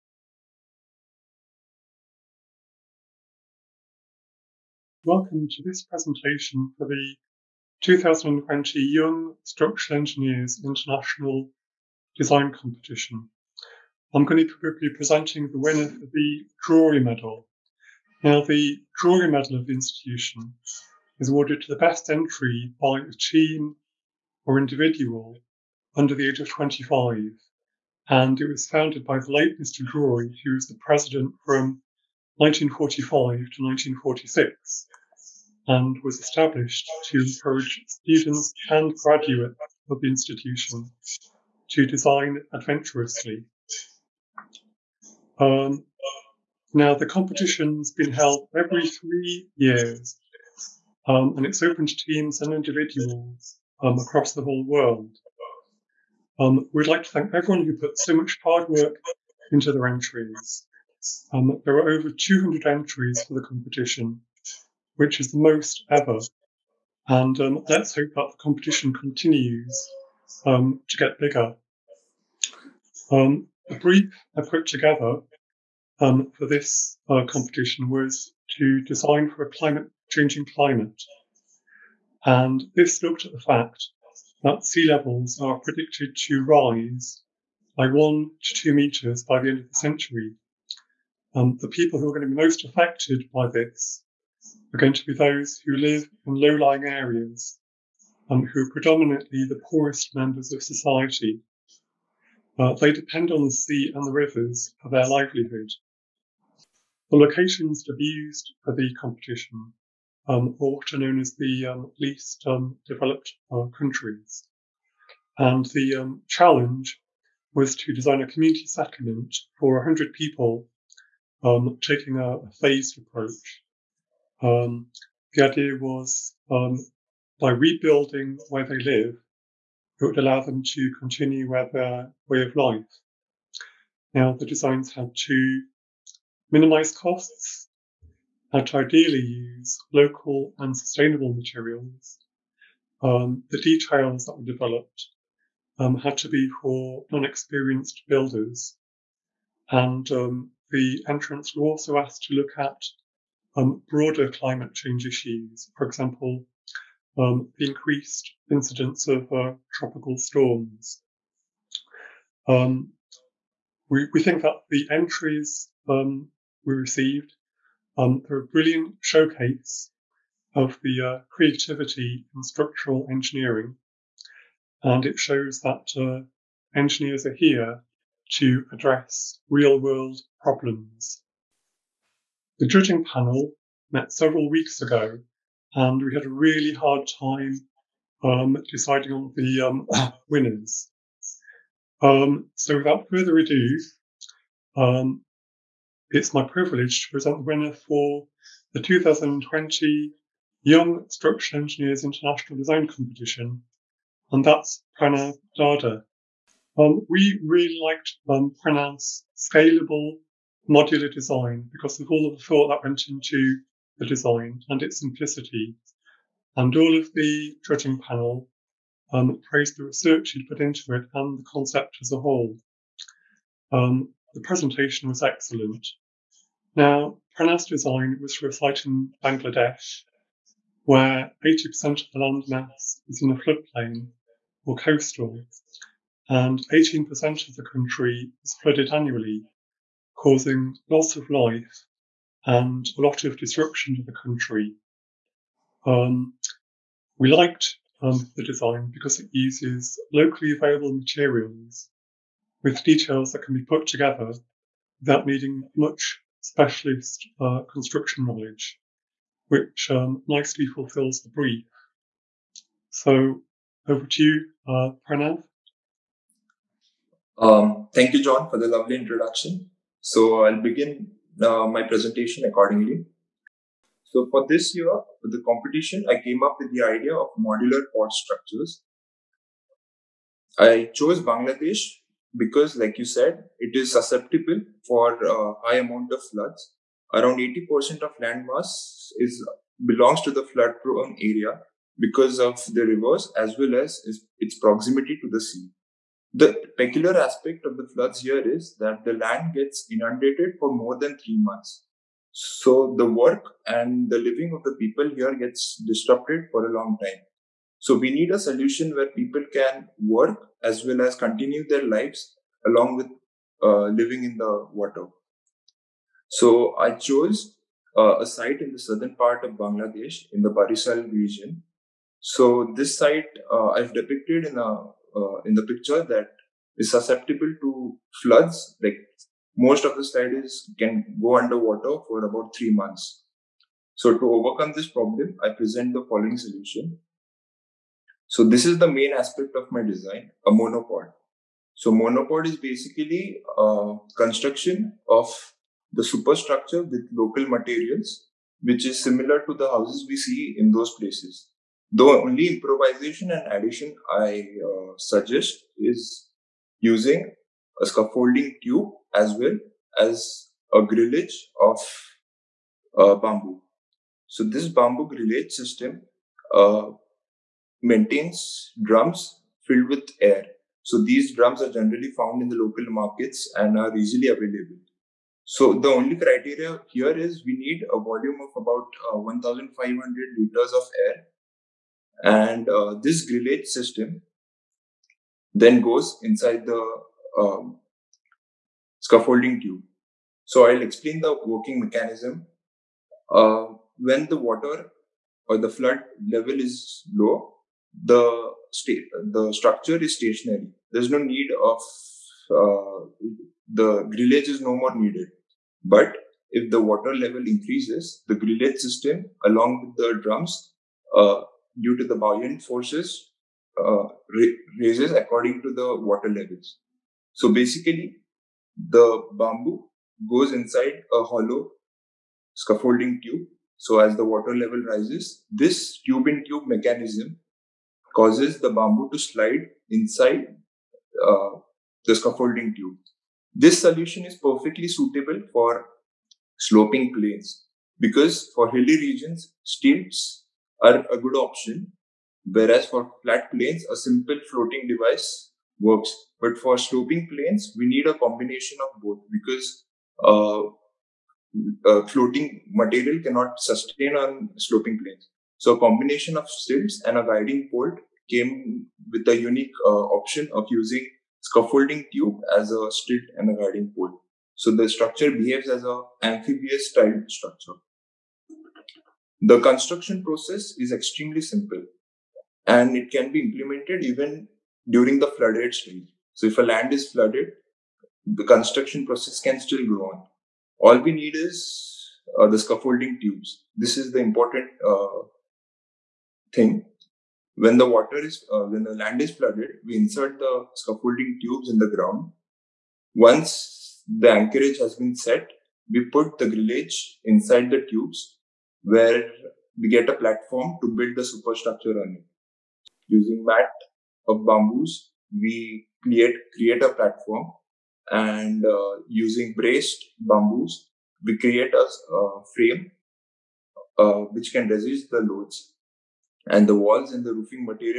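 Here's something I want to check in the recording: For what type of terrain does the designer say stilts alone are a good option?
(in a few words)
hilly regions.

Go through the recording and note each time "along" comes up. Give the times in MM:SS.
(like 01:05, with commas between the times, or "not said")
05:12, 06:49.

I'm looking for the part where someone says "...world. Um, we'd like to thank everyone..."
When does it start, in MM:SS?
00:54.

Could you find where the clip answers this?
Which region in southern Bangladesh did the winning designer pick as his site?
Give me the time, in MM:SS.
05:20.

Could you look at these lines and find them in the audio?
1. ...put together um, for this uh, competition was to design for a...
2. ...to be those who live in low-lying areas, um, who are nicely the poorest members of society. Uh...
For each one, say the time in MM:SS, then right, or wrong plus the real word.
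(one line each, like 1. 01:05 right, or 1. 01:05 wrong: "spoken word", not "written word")
1. 01:14 right
2. 01:34 wrong: "predominantly", not "nicely".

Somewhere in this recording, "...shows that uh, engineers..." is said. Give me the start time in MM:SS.
02:55.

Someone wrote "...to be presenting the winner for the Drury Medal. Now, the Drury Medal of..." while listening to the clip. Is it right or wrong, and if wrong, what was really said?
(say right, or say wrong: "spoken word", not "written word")
right.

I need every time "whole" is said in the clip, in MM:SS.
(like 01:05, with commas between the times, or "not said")
00:54, 03:42.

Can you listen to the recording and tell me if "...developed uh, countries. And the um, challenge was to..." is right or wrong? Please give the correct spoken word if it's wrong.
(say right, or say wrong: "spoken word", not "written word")
right.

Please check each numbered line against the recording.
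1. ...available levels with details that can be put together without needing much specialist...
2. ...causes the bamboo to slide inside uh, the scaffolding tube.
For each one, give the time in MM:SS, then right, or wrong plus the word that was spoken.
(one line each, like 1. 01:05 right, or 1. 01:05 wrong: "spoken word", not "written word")
1. 04:10 wrong: "materials", not "levels"
2. 07:08 right.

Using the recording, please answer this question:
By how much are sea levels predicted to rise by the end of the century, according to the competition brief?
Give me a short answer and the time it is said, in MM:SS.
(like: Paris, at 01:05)
1 to 2 meters, at 01:27.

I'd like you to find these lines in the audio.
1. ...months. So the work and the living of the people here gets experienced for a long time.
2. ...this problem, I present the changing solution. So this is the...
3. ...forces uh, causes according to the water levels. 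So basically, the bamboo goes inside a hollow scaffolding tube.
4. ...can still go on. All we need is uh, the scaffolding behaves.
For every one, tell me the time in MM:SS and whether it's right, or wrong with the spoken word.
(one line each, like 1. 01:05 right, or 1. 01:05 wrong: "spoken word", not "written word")
1. 05:01 wrong: "disrupted", not "experienced"
2. 05:34 wrong: "following", not "changing"
3. 06:52 wrong: "raises", not "causes"
4. 07:59 wrong: "tubes", not "behaves".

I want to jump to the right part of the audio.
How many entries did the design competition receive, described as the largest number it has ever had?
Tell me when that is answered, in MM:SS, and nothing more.
01:01.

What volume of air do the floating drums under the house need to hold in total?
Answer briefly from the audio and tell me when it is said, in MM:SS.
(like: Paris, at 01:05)
1,500 liters, at 06:19.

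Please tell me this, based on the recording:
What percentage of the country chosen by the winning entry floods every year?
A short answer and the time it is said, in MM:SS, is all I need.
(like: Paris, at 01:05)
18%, at 03:56.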